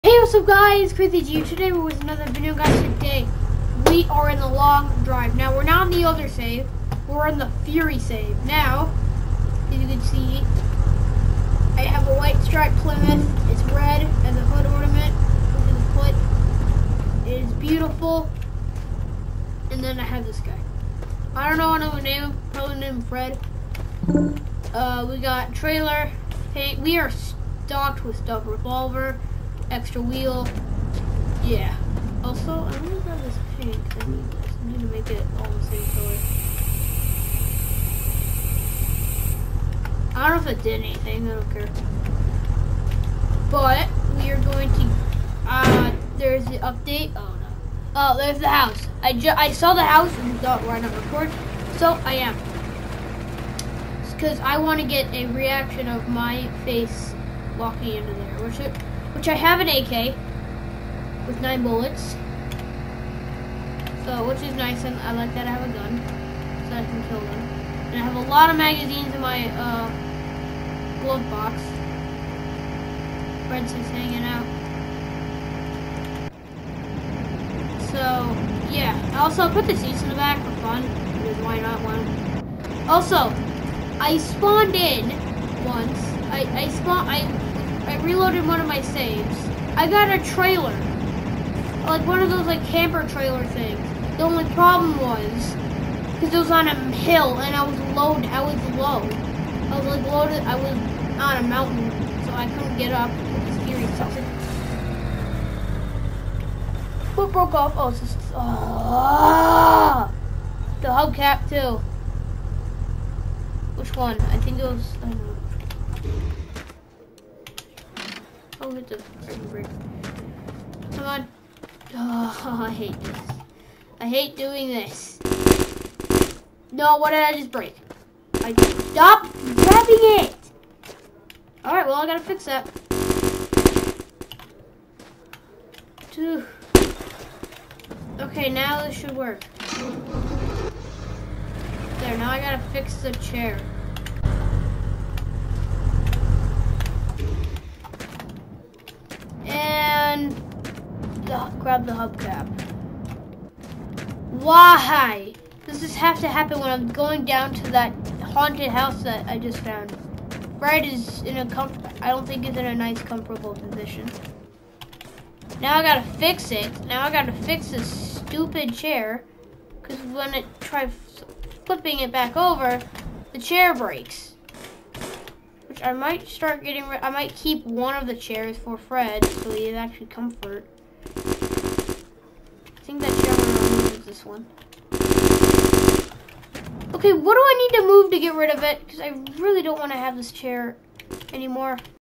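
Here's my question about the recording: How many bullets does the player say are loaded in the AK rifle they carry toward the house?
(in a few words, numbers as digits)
9.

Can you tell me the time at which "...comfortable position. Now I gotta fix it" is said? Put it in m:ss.
2:43.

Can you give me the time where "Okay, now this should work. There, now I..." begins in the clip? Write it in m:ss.
2:18.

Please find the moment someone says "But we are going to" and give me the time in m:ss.
0:43.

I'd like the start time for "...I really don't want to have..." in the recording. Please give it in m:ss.
3:08.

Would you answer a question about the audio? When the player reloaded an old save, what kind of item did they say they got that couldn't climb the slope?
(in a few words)
camper trailer.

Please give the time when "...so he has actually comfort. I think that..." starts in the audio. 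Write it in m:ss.
2:59.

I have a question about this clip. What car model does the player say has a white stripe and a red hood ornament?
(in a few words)
Plymouth.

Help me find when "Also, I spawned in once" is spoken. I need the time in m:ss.
1:22.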